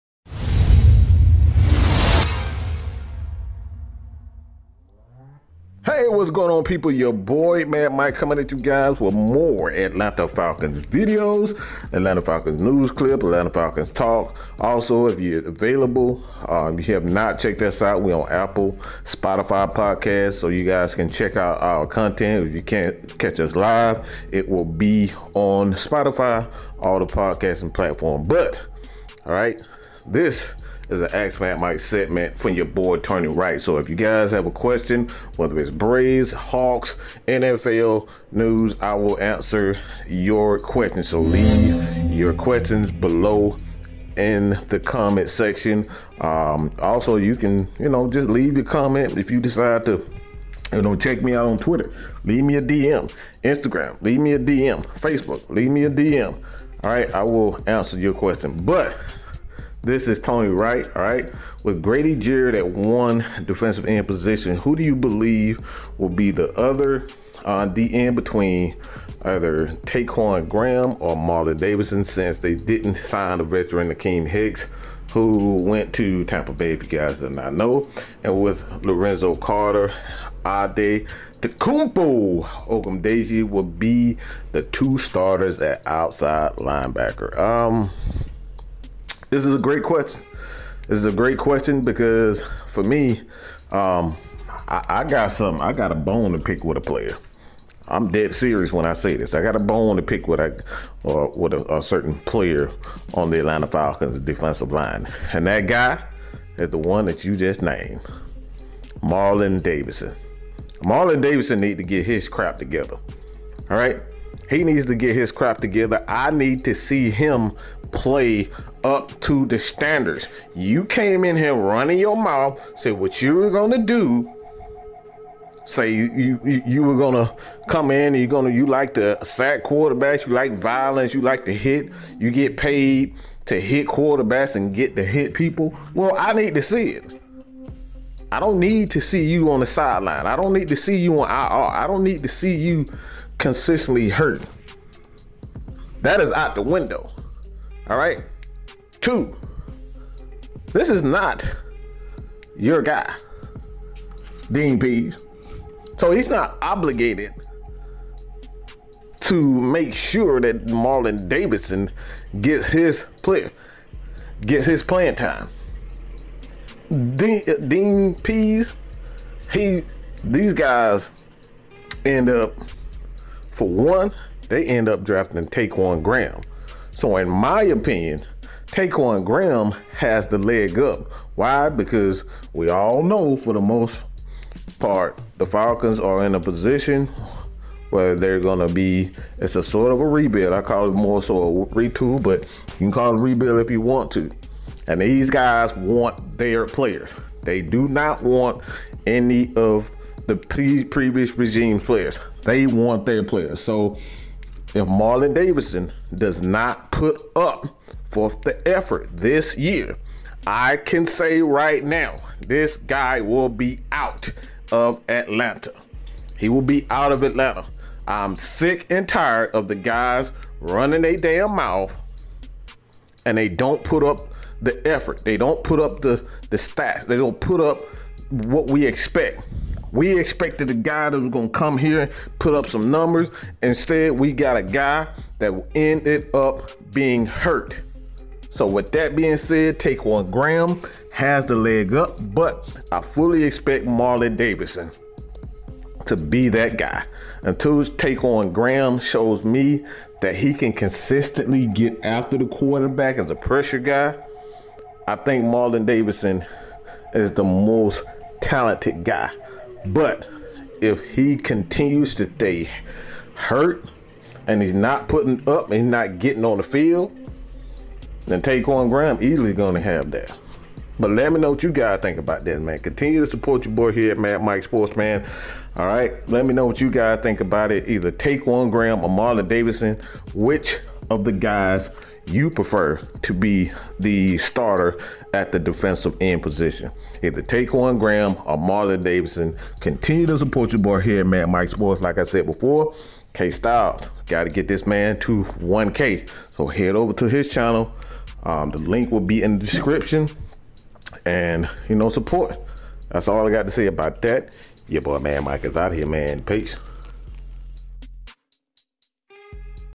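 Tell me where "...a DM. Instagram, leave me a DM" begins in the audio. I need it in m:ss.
0:52.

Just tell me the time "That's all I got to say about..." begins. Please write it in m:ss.
5:03.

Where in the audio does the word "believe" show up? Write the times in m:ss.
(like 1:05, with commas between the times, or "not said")
1:04.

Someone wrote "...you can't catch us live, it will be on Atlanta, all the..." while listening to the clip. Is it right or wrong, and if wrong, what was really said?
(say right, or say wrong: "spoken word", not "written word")
wrong: "Spotify", not "Atlanta".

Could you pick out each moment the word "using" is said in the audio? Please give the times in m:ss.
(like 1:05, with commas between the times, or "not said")
not said.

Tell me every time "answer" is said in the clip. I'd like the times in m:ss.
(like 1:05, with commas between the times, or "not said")
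0:39, 0:57.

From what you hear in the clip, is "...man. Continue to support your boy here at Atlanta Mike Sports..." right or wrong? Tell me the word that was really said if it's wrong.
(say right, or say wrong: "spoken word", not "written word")
wrong: "Mad", not "Atlanta".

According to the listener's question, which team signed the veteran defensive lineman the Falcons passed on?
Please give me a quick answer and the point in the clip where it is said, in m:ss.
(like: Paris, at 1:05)
Tampa Bay, at 1:16.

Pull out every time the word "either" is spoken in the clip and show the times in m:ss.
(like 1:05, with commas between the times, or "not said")
1:09, 4:37, 4:47.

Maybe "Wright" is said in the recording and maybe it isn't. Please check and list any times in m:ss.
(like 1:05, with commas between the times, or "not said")
0:33, 1:00.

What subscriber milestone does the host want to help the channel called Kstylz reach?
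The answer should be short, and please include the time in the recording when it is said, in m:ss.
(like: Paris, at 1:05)
1K, at 4:55.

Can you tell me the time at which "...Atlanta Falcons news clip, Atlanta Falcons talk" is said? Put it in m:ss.
0:11.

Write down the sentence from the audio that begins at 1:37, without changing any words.
I'm dead serious when I say this.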